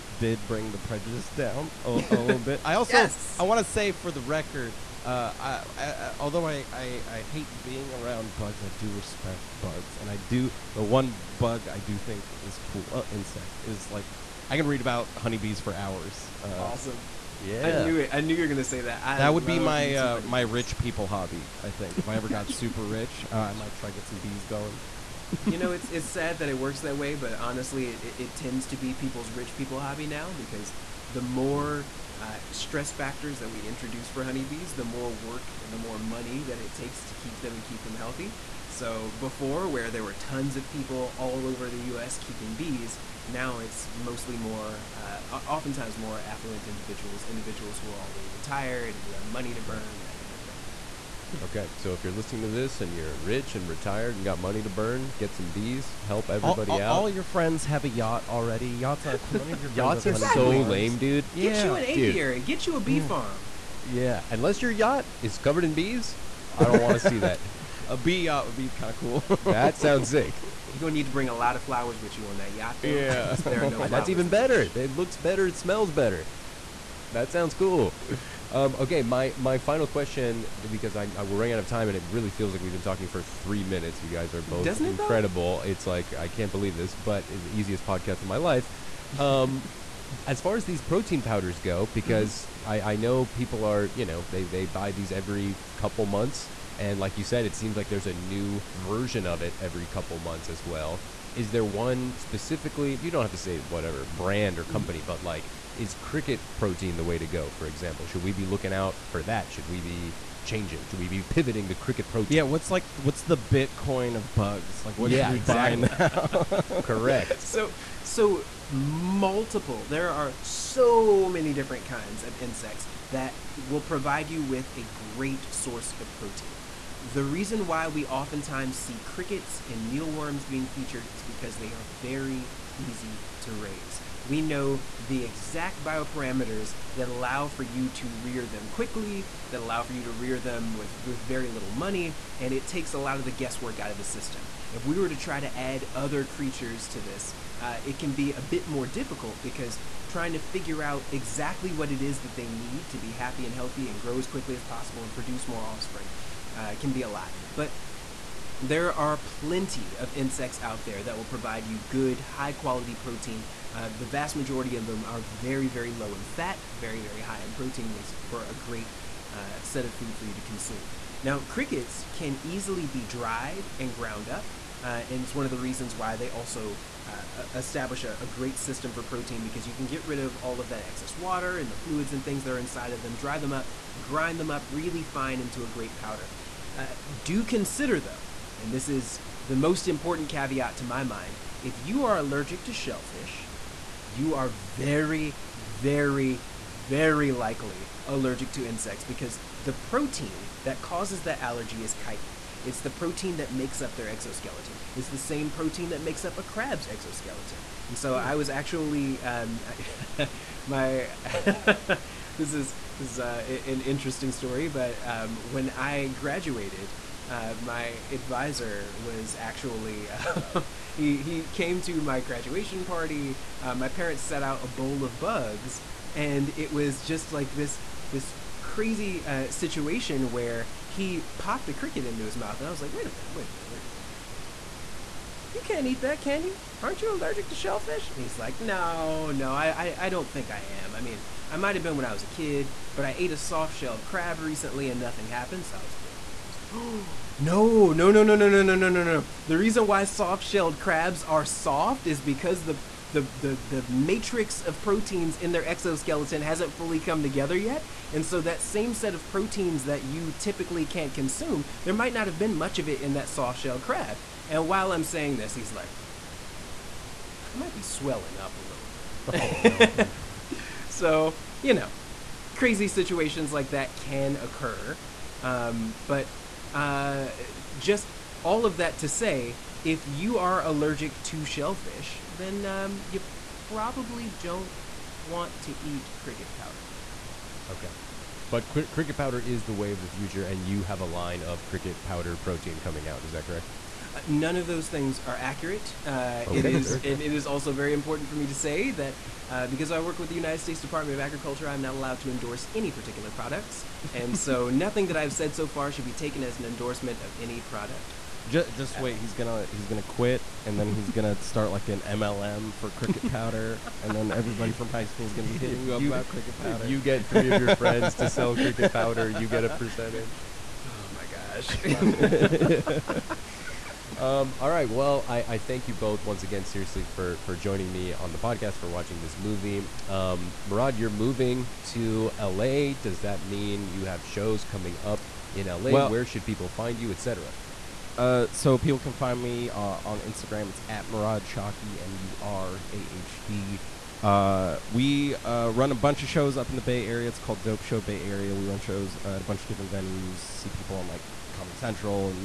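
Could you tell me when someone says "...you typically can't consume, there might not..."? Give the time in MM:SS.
04:20.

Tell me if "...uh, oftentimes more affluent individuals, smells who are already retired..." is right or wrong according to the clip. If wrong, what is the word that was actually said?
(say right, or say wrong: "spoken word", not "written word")
wrong: "individuals", not "smells".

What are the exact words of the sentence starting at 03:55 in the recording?
You can't eat that, can you?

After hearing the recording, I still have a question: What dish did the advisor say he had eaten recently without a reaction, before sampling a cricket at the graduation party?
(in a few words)
soft shell crab.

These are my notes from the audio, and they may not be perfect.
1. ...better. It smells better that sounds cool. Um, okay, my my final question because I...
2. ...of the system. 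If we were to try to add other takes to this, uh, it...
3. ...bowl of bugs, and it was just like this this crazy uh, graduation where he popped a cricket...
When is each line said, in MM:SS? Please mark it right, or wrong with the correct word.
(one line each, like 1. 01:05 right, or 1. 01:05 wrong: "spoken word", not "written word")
1. 01:15 right
2. 02:23 wrong: "creatures", not "takes"
3. 03:44 wrong: "situation", not "graduation".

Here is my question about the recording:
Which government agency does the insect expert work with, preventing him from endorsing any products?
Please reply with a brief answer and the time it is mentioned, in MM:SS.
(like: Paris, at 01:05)
United States Department of Agriculture, at 05:00.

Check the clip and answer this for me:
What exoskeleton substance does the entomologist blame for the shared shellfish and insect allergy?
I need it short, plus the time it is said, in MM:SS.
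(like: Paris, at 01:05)
chitin, at 03:21.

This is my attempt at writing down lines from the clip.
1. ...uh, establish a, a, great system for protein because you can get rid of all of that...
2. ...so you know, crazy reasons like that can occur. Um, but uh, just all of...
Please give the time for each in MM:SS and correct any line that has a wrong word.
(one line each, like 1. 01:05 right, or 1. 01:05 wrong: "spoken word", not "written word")
1. 02:57 right
2. 04:30 wrong: "situations", not "reasons".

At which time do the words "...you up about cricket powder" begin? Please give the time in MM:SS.
05:15.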